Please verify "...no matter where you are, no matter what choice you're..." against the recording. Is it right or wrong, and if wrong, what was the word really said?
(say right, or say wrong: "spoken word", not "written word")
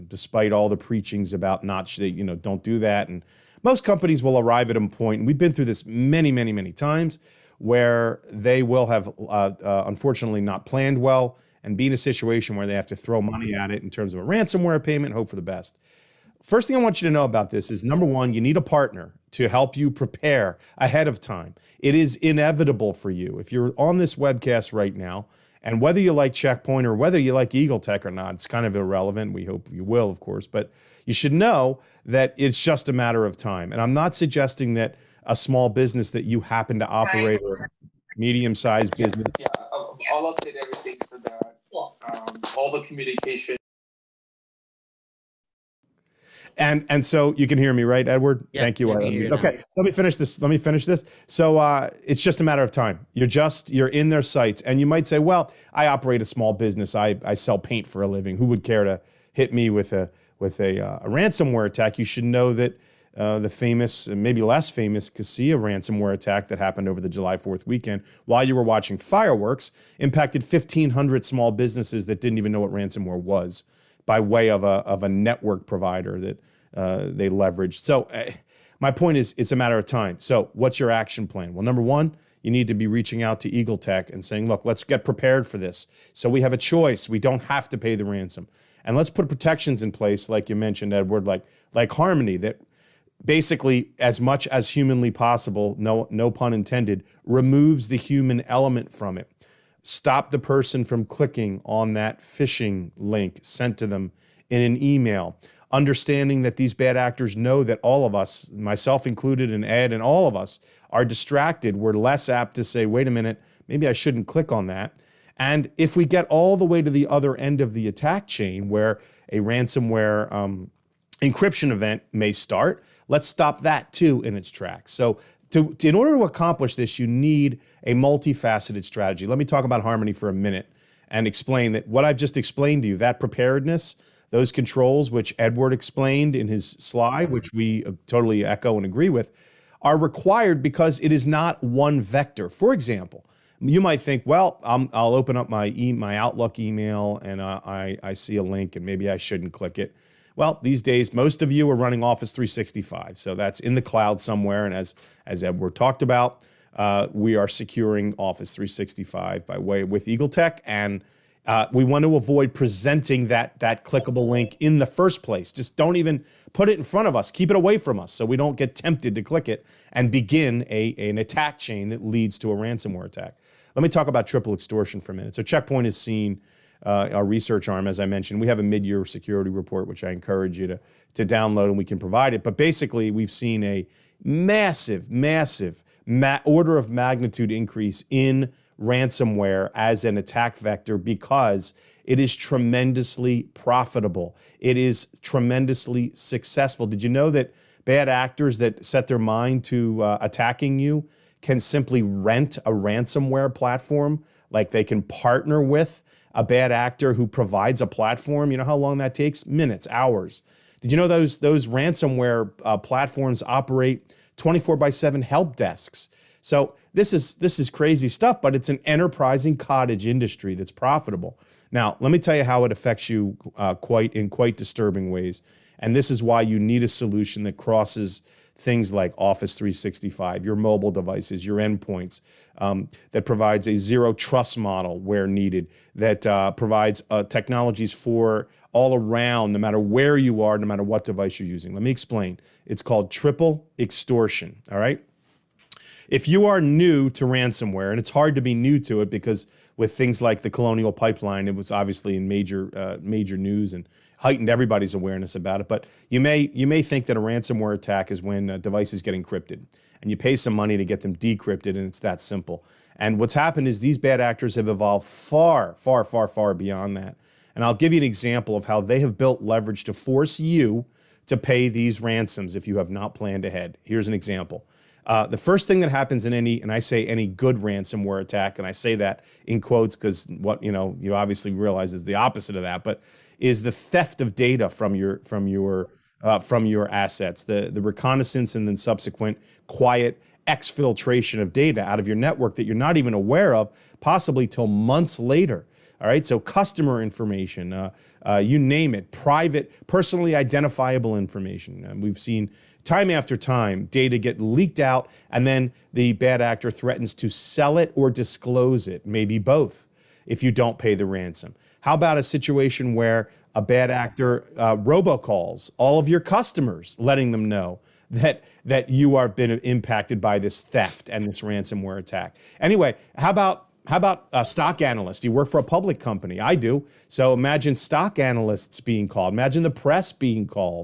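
wrong: "device", not "choice".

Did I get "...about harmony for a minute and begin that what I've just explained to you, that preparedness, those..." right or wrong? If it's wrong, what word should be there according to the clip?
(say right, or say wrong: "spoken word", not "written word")
wrong: "explain", not "begin".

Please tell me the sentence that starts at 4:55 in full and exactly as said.
All right, so customer information, uh, uh, you name it, private, personally identifiable information.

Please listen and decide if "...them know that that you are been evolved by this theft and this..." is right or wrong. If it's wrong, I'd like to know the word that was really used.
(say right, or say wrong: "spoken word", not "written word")
wrong: "impacted", not "evolved".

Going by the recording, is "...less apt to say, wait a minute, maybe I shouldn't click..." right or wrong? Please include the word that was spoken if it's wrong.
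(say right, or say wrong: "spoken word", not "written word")
right.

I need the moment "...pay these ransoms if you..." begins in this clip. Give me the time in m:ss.
4:31.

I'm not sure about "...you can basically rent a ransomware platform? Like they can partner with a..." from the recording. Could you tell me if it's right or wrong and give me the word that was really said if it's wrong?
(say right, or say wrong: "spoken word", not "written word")
wrong: "simply", not "basically".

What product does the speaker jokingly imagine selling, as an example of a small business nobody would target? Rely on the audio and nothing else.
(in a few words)
paint.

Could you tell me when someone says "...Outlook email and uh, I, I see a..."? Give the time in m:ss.
2:26.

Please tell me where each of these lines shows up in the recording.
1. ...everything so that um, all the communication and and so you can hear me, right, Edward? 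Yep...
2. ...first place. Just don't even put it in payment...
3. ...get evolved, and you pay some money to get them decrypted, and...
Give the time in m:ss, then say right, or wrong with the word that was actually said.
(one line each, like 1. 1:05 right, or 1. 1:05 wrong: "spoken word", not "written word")
1. 0:40 right
2. 2:44 wrong: "front", not "payment"
3. 4:19 wrong: "encrypted", not "evolved".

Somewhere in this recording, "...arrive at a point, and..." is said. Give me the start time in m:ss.
0:04.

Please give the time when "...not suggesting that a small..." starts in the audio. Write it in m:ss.
0:33.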